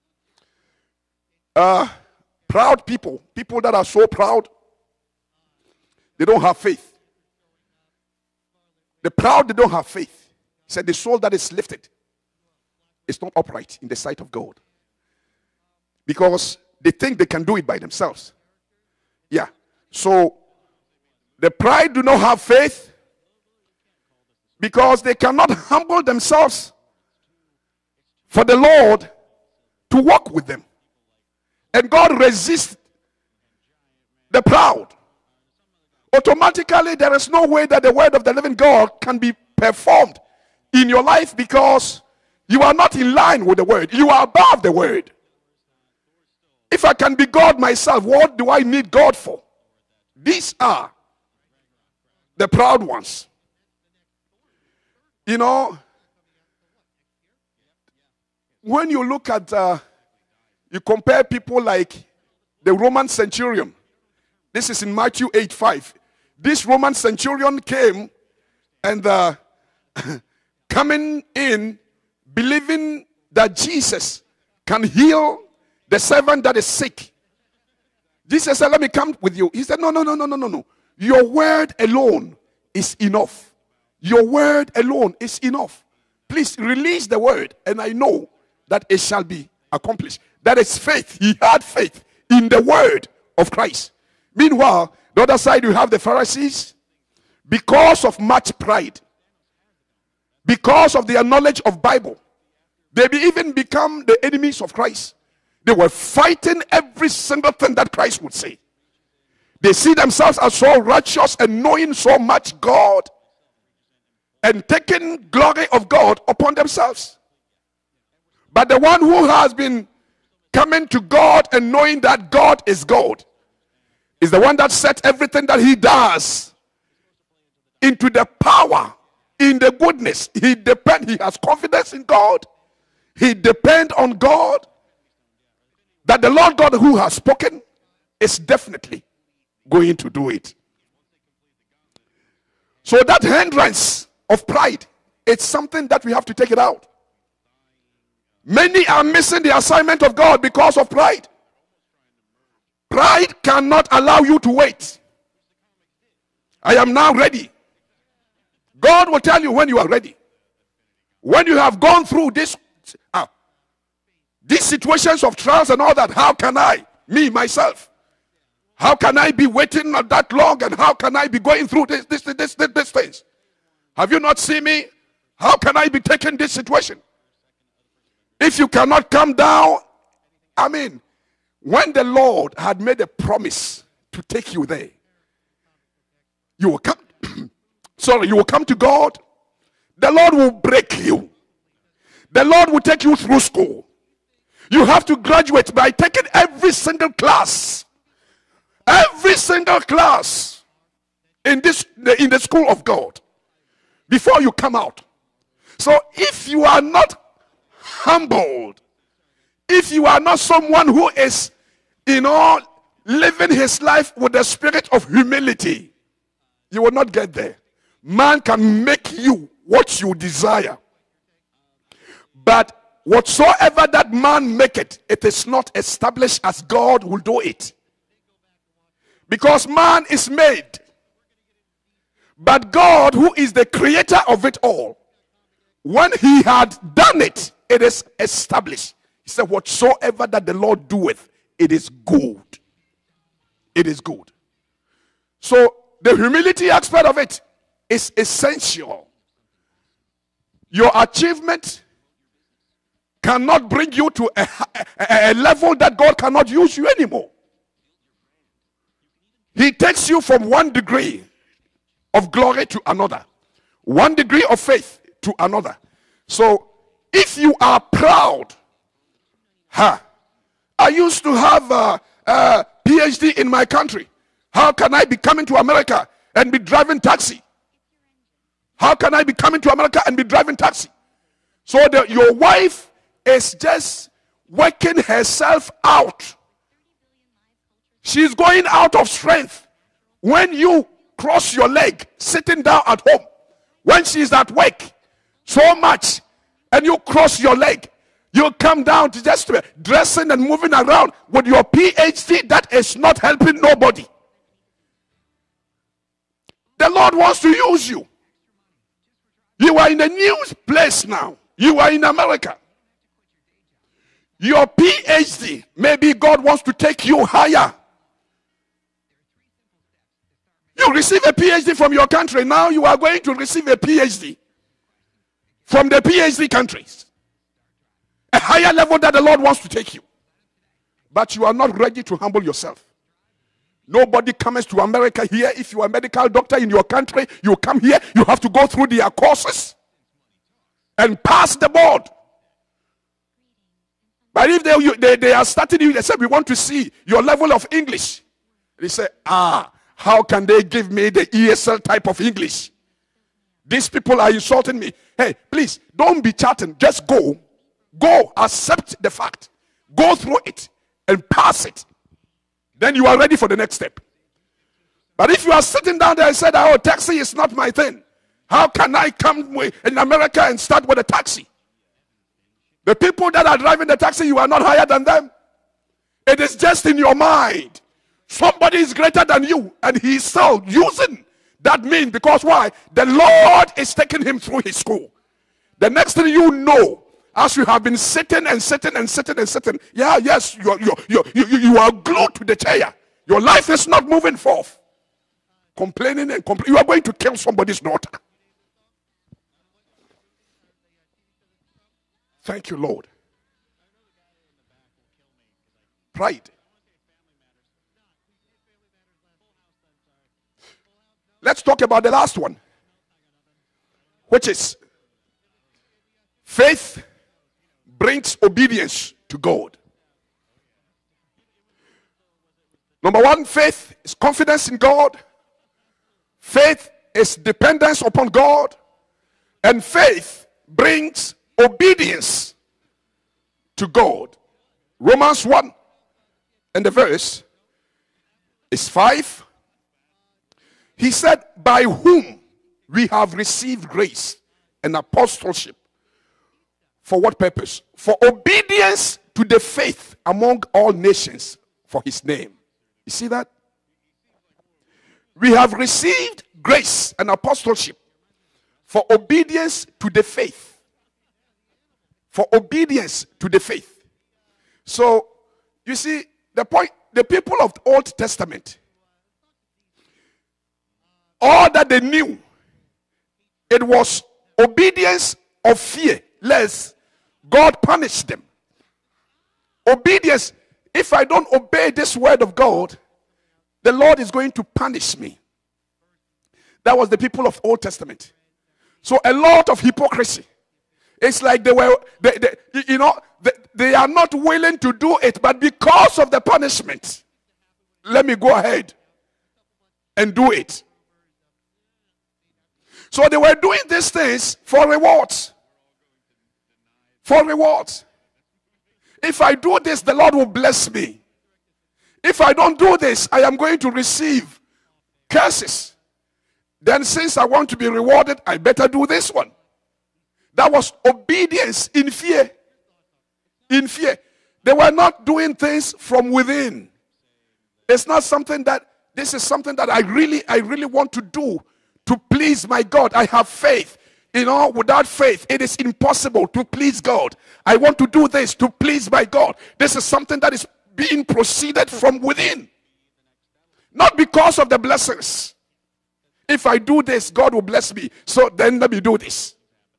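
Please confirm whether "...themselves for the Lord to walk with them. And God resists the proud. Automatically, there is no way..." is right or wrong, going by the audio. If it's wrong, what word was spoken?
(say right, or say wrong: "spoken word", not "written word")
right.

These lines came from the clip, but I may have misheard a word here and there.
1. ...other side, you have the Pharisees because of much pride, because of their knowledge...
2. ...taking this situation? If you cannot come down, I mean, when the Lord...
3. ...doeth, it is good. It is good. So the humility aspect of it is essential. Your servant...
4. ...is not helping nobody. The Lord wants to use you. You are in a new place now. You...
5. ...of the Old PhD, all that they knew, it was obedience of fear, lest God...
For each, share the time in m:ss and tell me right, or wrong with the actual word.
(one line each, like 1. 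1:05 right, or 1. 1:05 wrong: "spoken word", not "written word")
1. 1:35 right
2. 2:56 right
3. 4:00 wrong: "achievement", not "servant"
4. 5:02 right
5. 7:47 wrong: "Testament", not "PhD".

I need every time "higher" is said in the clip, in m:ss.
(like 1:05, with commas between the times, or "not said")
5:17, 5:28, 6:14.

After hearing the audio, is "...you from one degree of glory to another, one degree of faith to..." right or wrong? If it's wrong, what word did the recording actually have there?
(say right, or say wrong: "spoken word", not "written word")
right.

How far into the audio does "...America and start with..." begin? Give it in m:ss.
6:09.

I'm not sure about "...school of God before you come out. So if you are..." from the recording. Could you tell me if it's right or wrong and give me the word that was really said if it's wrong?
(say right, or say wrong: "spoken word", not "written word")
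right.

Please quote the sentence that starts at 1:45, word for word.
They were fighting every single thing that Christ would say.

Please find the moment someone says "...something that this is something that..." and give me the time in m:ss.
8:48.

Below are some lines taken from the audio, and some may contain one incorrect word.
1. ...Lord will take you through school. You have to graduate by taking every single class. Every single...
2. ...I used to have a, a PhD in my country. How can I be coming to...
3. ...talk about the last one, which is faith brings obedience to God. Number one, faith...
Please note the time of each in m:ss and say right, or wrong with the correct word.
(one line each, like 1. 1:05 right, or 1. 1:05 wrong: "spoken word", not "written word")
1. 3:12 right
2. 4:30 right
3. 6:51 right.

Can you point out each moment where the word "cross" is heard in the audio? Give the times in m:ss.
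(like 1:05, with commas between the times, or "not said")
4:51, 4:56.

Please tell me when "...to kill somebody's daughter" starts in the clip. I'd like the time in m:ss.
6:37.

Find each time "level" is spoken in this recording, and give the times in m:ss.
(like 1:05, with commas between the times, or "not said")
4:15, 5:28, 5:47.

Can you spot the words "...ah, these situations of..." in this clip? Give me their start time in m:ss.
2:43.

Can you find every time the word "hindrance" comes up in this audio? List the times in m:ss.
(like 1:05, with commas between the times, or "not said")
2:23.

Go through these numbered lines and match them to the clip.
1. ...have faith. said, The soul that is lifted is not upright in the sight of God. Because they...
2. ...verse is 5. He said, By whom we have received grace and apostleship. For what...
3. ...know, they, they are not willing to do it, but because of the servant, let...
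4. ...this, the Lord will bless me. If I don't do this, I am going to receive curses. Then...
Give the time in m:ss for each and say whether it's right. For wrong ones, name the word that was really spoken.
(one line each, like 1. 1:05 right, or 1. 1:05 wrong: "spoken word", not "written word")
1. 0:09 right
2. 7:16 right
3. 8:12 wrong: "punishment", not "servant"
4. 8:29 right.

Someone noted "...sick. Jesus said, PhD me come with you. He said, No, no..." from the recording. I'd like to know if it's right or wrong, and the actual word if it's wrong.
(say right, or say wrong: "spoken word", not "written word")
wrong: "Let", not "PhD".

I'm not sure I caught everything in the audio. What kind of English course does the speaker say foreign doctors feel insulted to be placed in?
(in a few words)
ESL.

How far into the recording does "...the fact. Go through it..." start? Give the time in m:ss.
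5:59.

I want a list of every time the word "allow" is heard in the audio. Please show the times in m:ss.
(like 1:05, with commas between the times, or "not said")
2:33.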